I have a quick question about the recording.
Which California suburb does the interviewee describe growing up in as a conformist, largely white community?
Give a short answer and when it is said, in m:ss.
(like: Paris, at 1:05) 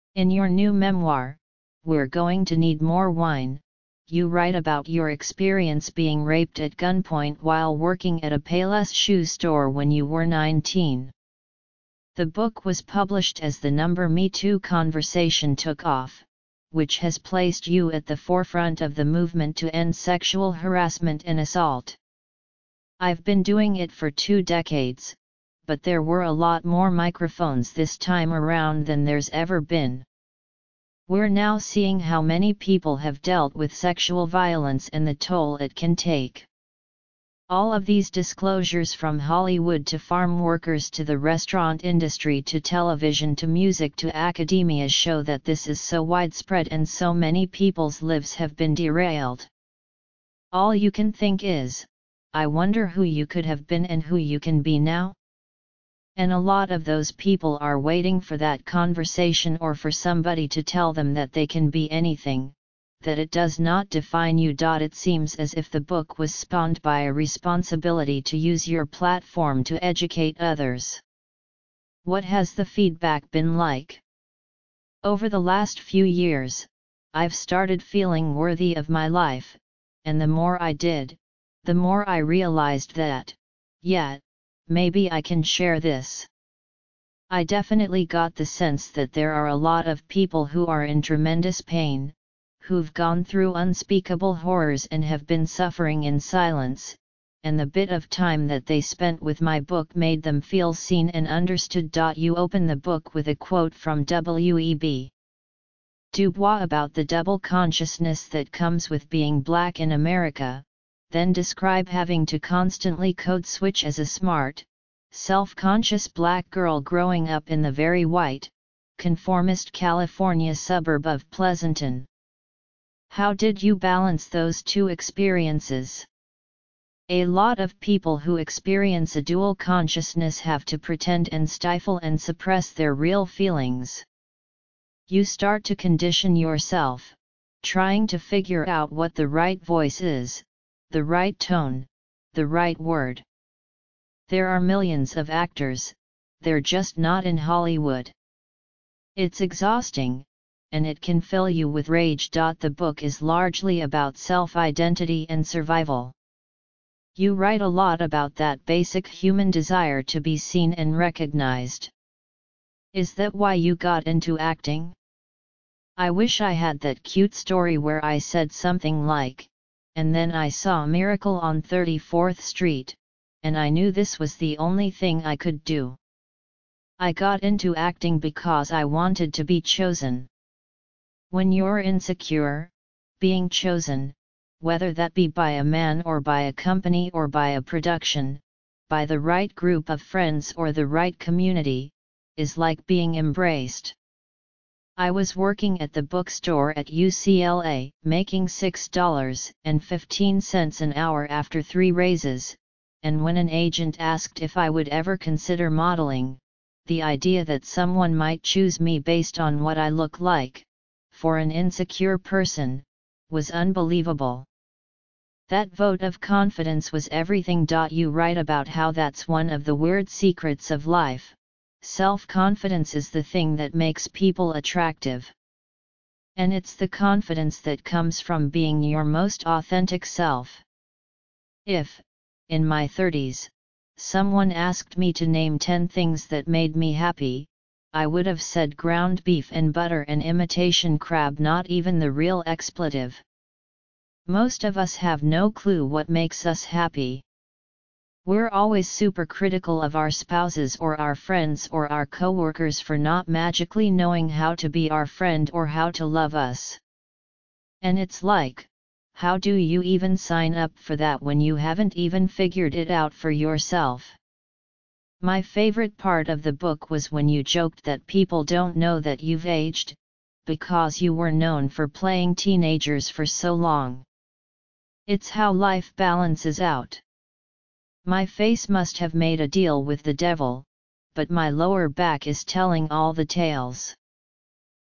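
Pleasanton, at 2:01.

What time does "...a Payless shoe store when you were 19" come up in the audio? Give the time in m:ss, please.
0:08.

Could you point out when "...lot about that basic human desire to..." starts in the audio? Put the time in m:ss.
2:37.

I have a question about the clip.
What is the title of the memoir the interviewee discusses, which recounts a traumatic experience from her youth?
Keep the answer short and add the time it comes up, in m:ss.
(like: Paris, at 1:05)
We're Going to Need More Wine, at 0:01.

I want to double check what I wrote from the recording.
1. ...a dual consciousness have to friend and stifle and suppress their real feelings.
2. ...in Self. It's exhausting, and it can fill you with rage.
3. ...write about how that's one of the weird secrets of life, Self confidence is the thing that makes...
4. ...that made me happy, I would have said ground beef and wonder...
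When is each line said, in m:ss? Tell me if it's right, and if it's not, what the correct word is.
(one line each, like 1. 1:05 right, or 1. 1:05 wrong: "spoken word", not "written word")
1. 2:09 wrong: "pretend", not "friend"
2. 2:27 wrong: "Hollywood", not "Self"
3. 3:38 right
4. 3:56 wrong: "butter", not "wonder".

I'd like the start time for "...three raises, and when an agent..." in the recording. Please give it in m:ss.
3:21.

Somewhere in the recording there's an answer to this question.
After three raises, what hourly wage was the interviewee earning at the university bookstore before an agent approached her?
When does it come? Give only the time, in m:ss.
3:18.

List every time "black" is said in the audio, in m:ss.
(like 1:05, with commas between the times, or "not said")
1:49, 1:56.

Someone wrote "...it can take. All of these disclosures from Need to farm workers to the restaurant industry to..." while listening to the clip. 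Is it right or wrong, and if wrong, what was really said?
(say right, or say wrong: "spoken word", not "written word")
wrong: "Hollywood", not "Need".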